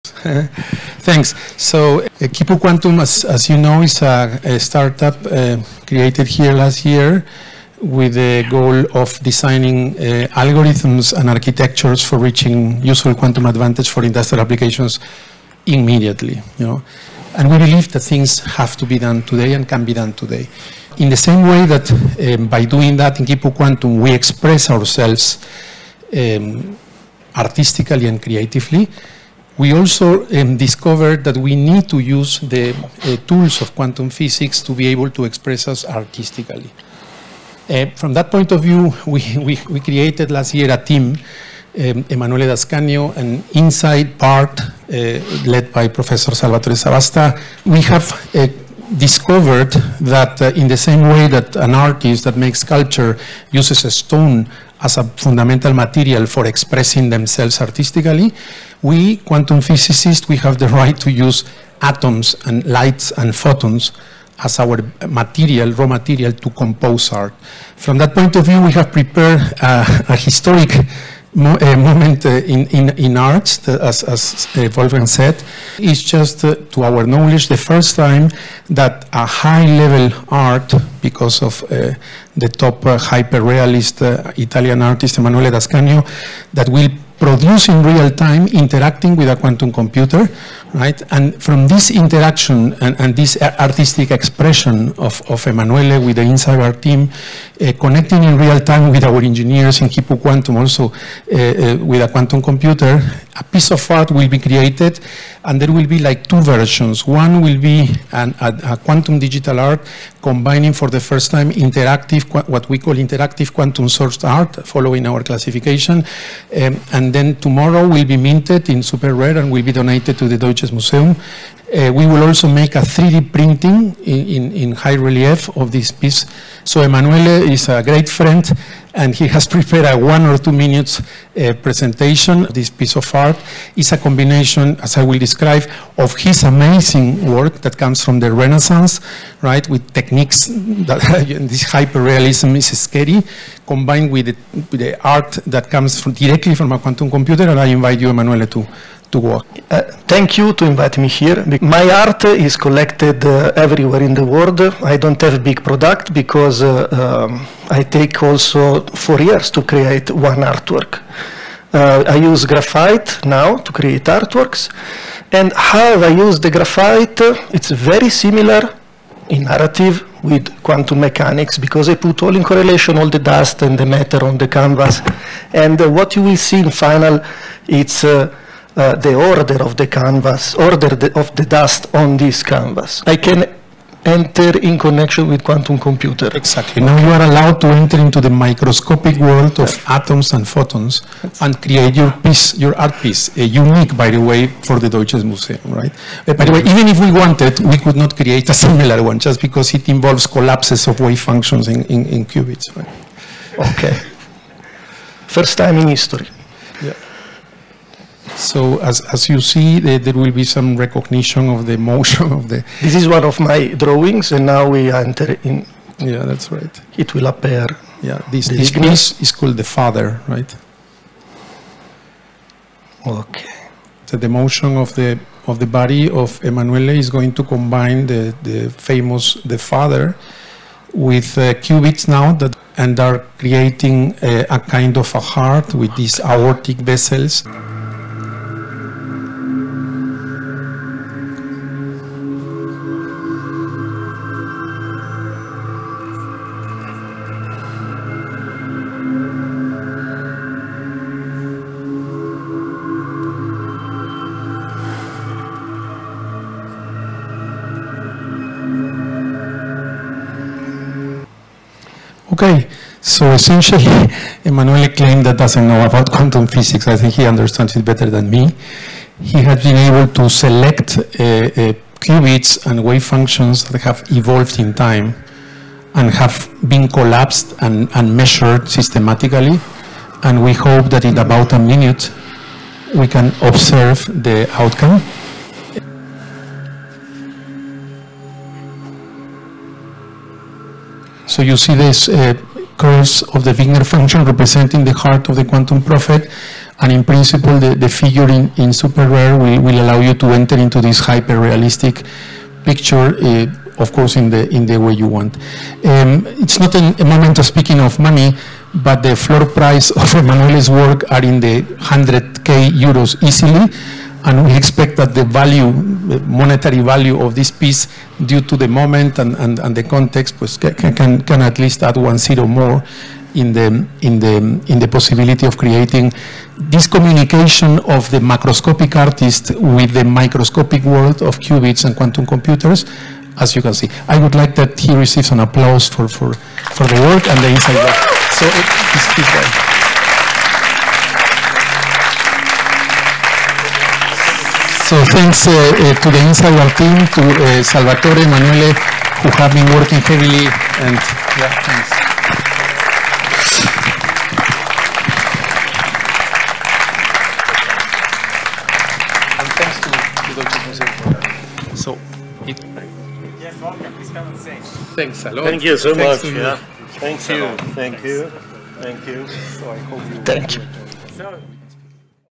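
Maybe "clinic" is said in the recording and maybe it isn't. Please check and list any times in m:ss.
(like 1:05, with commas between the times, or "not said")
not said.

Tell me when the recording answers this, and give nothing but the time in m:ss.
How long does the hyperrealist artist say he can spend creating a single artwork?
2:39.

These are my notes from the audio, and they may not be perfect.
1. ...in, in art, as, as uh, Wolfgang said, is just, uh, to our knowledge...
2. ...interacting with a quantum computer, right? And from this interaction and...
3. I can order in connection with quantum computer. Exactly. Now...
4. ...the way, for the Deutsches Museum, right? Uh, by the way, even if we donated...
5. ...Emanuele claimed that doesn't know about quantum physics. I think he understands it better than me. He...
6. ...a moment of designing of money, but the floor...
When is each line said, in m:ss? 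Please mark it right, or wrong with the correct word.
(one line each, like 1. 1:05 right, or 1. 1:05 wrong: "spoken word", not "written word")
1. 1:12 right
2. 1:28 right
3. 3:03 wrong: "enter", not "order"
4. 3:14 wrong: "wanted", not "donated"
5. 4:24 right
6. 5:06 wrong: "speaking", not "designing".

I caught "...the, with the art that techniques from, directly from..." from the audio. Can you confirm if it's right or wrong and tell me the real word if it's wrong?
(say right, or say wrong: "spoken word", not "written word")
wrong: "comes", not "techniques".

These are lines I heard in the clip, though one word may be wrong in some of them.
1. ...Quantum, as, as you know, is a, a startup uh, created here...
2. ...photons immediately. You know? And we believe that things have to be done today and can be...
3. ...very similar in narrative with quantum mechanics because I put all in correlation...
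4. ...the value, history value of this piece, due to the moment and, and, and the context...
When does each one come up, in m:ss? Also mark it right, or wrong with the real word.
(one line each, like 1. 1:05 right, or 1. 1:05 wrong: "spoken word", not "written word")
1. 0:02 right
2. 0:14 wrong: "applications", not "photons"
3. 2:47 right
4. 5:15 wrong: "monetary", not "history".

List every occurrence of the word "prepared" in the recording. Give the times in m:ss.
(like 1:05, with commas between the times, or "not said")
1:08, 2:09.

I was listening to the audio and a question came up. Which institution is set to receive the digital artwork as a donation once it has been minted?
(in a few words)
Deutsche Museum.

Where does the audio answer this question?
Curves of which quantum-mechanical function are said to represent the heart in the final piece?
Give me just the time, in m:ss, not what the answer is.
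4:53.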